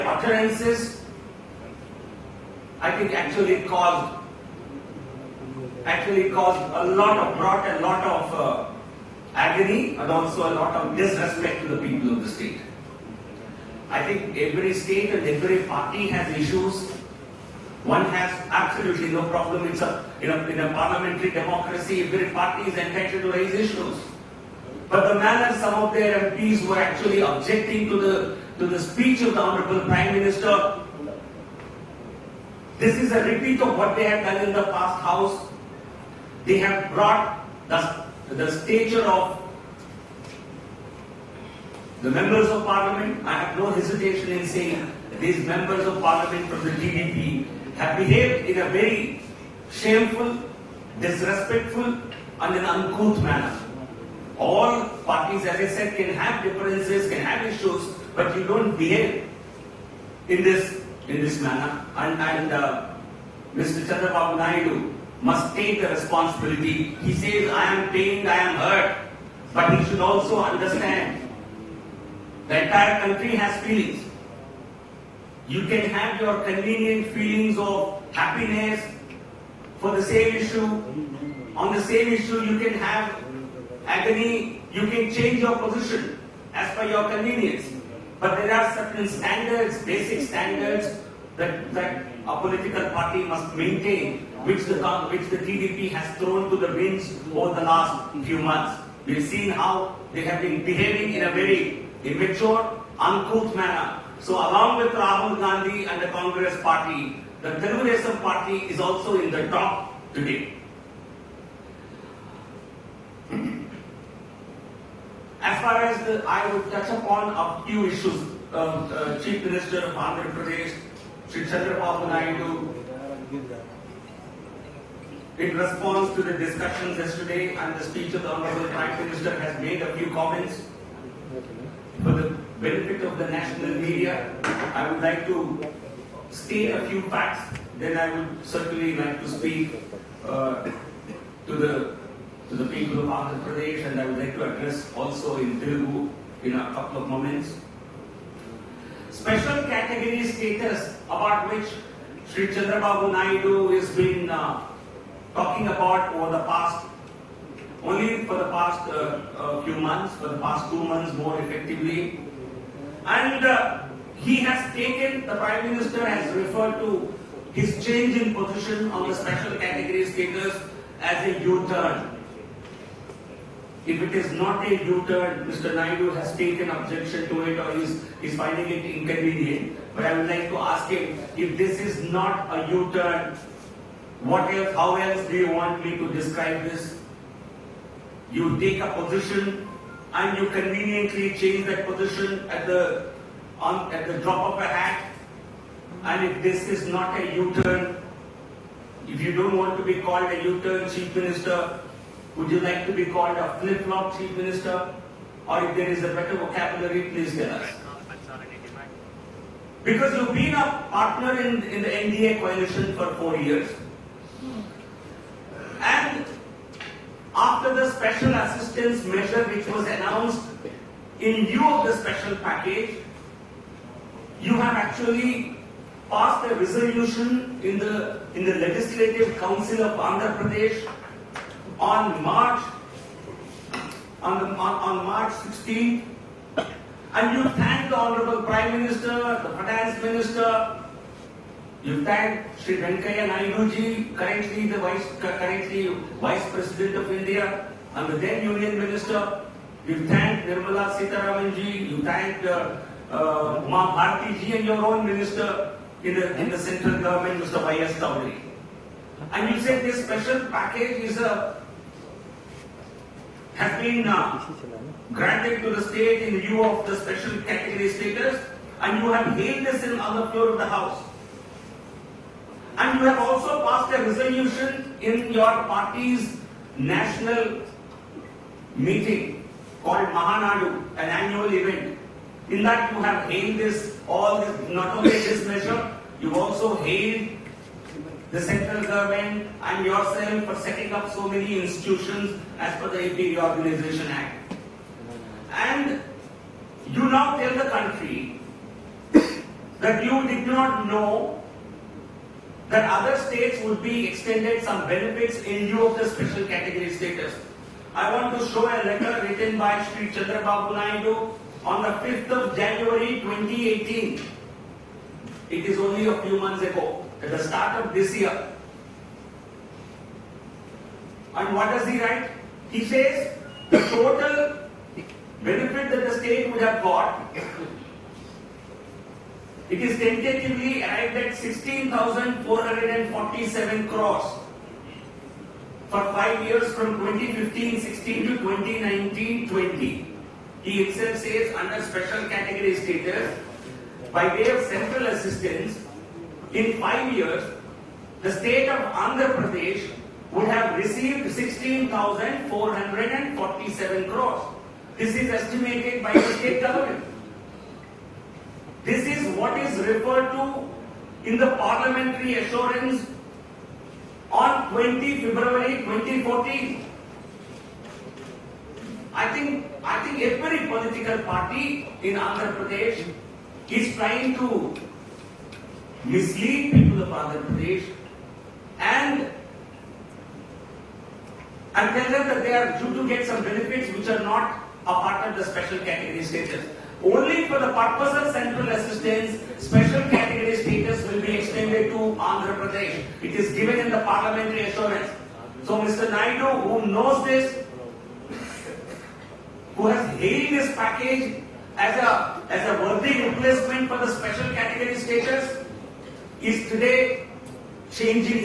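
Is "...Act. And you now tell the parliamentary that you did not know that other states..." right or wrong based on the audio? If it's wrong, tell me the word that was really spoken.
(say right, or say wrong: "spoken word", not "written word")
wrong: "country", not "parliamentary".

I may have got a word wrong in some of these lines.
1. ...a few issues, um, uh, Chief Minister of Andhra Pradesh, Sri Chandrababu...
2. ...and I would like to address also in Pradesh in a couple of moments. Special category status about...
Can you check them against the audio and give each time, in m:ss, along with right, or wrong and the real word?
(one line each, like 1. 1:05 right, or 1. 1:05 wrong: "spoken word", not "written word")
1. 1:57 right
2. 2:23 wrong: "Telugu", not "Pradesh".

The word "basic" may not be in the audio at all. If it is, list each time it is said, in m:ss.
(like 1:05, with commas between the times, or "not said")
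1:29.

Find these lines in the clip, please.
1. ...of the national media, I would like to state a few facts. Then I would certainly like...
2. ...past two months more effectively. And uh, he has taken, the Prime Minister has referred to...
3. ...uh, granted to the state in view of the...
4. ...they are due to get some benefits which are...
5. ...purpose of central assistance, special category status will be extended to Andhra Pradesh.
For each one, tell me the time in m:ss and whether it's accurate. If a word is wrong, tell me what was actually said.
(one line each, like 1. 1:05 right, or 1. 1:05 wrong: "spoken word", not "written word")
1. 2:13 right
2. 2:40 right
3. 4:24 right
4. 6:22 right
5. 6:27 right.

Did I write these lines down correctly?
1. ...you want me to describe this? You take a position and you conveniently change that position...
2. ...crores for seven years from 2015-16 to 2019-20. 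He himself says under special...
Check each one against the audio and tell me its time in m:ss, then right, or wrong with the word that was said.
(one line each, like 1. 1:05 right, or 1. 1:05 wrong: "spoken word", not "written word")
1. 3:05 right
2. 5:33 wrong: "five", not "seven".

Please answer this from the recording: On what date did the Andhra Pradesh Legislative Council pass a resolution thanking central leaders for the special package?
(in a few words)
March 16th.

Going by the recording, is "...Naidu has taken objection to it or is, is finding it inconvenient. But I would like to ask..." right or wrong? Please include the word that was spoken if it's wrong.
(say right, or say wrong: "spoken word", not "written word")
right.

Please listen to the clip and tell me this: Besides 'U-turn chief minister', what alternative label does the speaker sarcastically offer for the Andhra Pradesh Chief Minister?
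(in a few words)
flip-flop chief minister.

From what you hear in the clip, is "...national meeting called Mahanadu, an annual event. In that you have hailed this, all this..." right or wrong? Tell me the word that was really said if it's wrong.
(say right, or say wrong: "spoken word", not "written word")
right.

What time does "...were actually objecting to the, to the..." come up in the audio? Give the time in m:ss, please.
0:26.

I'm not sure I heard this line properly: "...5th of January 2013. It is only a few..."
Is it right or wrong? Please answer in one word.
wrong.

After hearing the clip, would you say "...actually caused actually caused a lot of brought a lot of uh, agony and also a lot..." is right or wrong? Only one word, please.
right.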